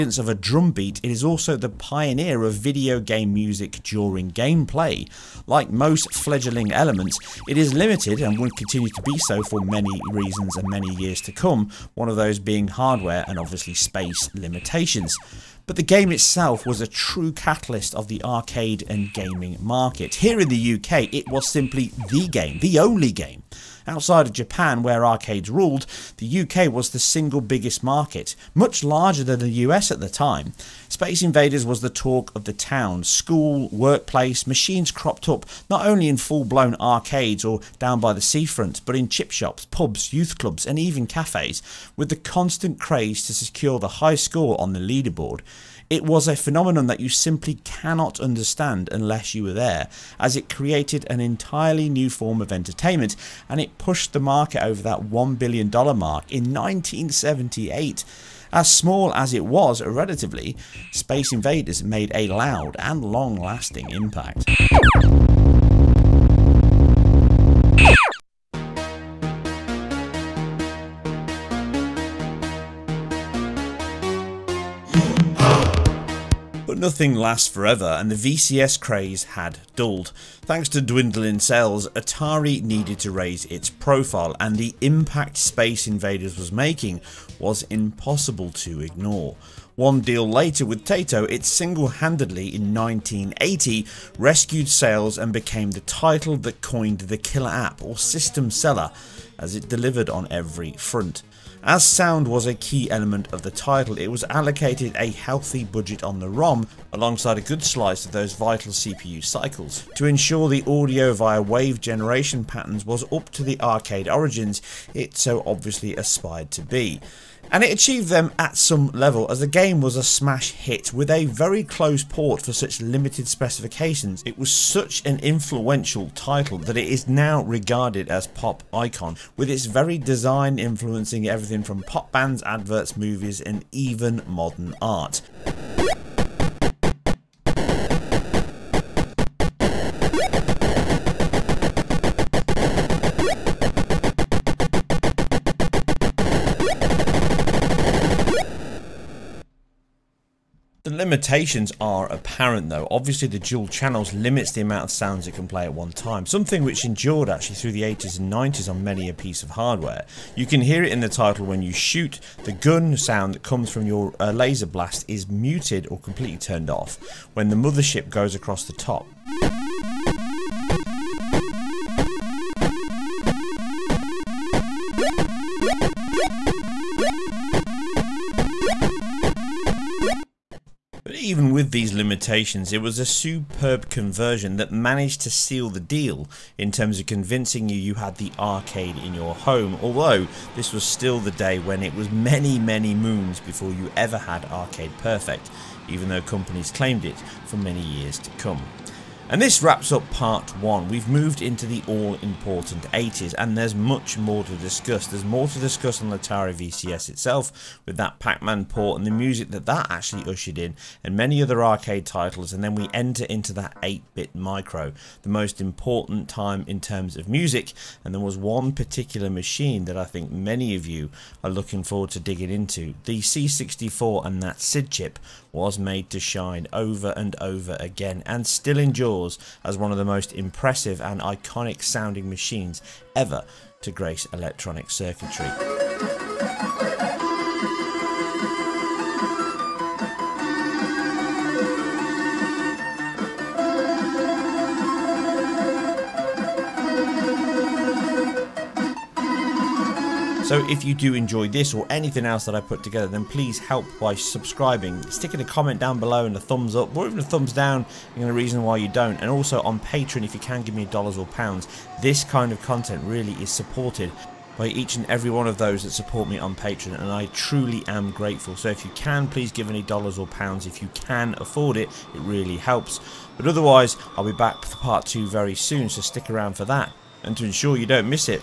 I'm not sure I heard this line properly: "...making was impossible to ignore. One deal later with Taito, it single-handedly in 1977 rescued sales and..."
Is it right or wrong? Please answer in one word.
wrong.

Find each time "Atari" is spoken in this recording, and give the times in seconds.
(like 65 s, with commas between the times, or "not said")
81 s, 206 s.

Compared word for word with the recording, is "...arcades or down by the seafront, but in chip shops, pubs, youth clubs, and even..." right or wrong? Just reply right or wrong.
right.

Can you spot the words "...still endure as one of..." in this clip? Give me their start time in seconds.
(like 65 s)
228 s.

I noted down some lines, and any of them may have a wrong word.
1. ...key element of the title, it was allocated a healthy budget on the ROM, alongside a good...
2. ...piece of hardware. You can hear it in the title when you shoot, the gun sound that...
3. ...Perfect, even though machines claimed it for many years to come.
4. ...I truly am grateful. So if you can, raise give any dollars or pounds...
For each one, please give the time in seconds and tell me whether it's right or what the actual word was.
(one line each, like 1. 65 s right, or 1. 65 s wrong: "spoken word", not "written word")
1. 102 s right
2. 159 s right
3. 194 s wrong: "companies", not "machines"
4. 267 s wrong: "please", not "raise".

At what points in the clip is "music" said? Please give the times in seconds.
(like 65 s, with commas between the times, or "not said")
3 s, 209 s, 217 s.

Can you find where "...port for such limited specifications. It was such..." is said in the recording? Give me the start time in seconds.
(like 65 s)
122 s.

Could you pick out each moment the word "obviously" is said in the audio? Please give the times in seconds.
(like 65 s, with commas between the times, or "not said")
13 s, 115 s, 152 s.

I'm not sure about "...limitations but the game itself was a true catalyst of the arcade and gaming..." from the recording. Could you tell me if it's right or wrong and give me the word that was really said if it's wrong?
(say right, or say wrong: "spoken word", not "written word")
right.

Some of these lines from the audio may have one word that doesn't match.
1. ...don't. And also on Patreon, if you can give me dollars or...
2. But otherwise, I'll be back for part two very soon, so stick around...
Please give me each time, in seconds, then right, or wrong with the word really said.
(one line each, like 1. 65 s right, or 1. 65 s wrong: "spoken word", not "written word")
1. 258 s right
2. 273 s right.